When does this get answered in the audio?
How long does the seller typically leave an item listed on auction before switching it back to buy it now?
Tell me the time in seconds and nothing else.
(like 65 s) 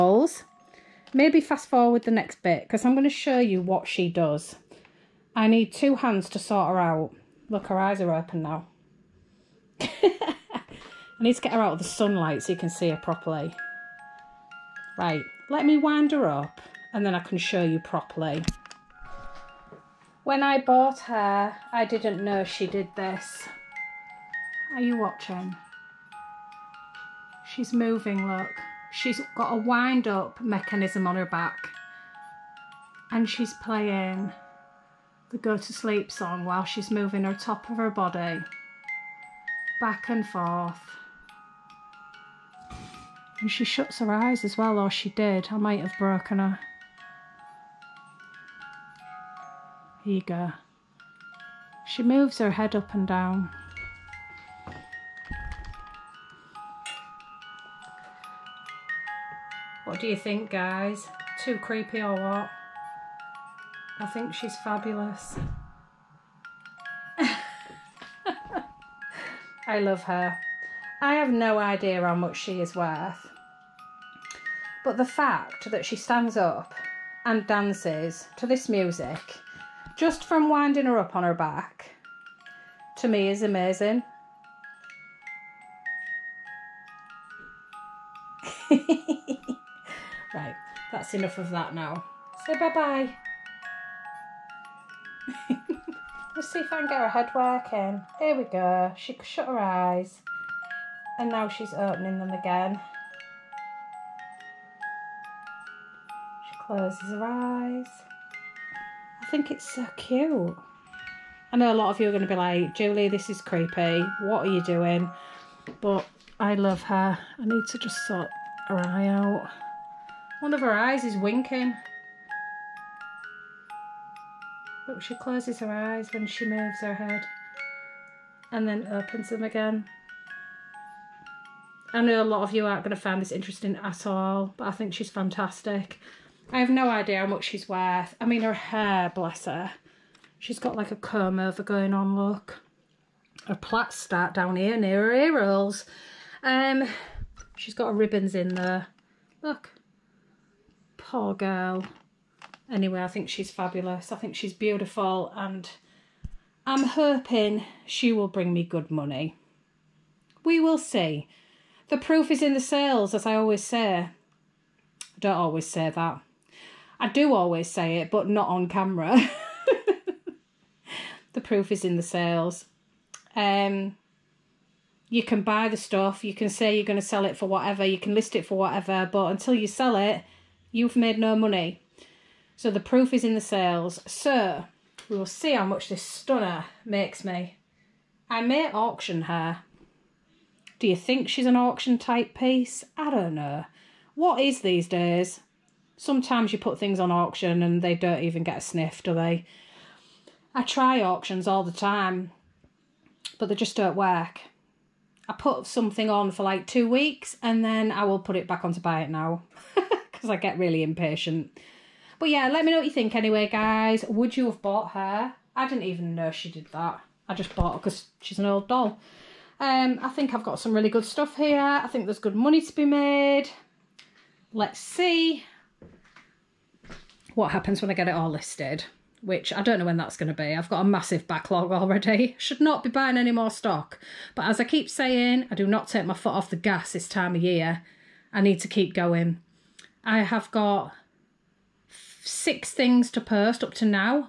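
206 s.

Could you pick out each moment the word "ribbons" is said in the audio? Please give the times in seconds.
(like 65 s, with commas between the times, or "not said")
147 s.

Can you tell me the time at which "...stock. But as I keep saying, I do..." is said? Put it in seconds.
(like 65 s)
233 s.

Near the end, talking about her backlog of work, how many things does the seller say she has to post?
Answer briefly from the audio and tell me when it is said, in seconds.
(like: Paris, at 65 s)
6, at 242 s.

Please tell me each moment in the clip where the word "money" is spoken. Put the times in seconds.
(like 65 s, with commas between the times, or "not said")
158 s, 181 s, 222 s.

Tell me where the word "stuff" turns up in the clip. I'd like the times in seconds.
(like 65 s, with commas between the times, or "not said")
175 s, 221 s.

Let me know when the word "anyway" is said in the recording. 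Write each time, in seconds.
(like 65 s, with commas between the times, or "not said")
152 s, 213 s.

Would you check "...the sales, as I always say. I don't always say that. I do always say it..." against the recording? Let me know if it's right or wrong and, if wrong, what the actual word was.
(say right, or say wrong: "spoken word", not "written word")
right.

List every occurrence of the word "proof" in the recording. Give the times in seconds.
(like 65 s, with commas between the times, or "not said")
161 s, 171 s, 182 s.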